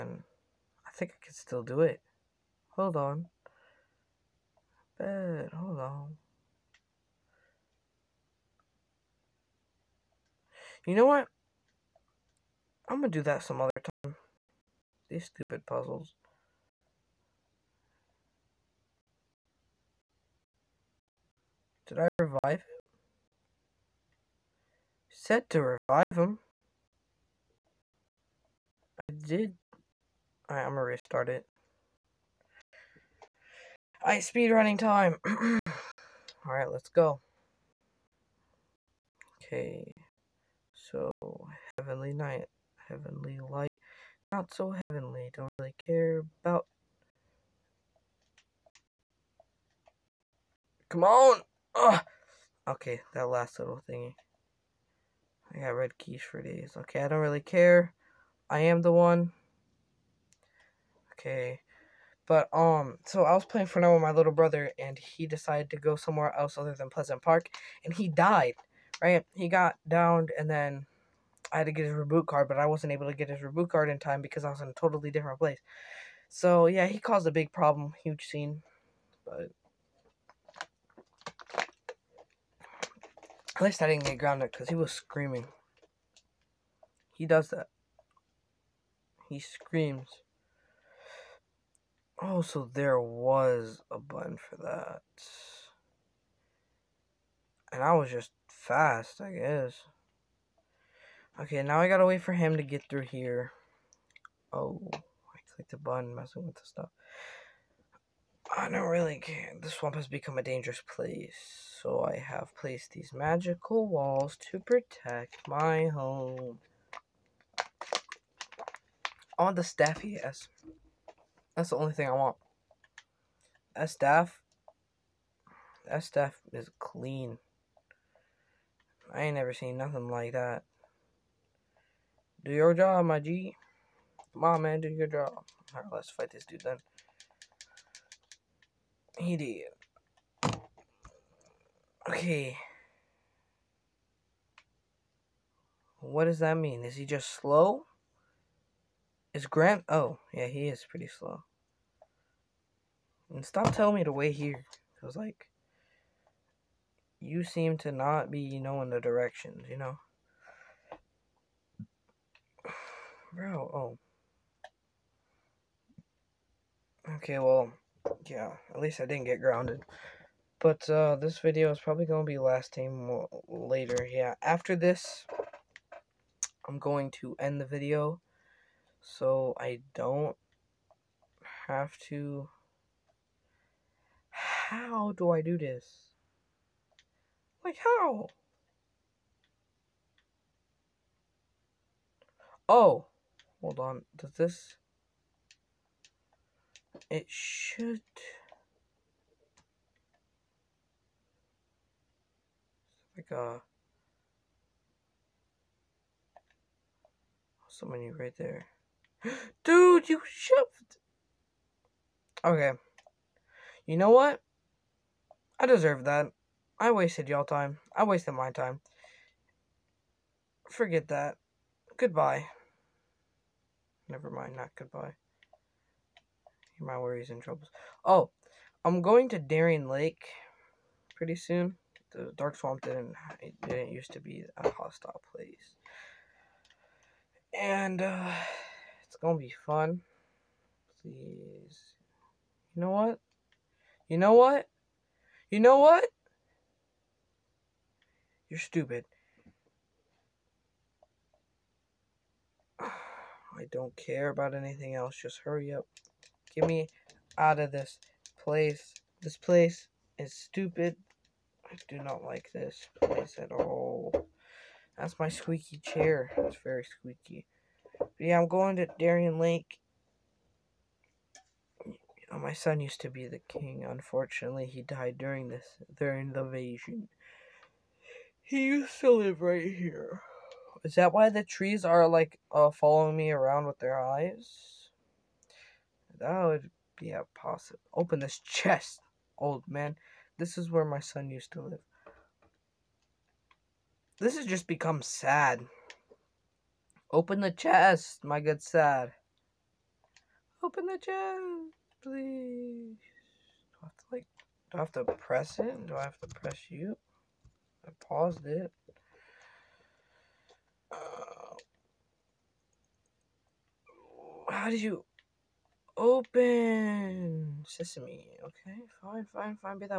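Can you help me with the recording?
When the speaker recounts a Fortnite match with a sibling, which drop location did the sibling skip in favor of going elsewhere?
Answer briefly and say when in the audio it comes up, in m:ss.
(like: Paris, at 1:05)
Pleasant Park, at 1:06.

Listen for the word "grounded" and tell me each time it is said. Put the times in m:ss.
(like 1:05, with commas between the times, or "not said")
1:24, 2:49.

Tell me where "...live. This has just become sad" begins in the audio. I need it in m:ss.
4:51.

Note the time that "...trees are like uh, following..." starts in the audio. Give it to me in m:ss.
4:41.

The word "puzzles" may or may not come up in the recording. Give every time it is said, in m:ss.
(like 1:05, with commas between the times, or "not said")
0:15.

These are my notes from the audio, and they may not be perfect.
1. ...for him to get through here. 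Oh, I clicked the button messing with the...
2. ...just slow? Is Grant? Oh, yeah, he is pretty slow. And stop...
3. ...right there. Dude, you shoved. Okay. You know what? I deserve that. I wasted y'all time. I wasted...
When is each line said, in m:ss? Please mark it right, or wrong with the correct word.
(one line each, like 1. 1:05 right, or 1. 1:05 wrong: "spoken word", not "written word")
1. 1:42 right
2. 2:27 right
3. 3:28 right.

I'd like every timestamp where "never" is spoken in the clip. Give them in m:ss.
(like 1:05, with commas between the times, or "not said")
2:09, 3:44.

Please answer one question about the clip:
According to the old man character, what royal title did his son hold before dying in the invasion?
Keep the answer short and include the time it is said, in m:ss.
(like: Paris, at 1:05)
king, at 4:33.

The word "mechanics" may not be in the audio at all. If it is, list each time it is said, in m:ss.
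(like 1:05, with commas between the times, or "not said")
not said.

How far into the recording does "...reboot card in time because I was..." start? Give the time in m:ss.
1:13.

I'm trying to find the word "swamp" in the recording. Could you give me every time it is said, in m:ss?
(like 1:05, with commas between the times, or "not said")
1:49, 3:52.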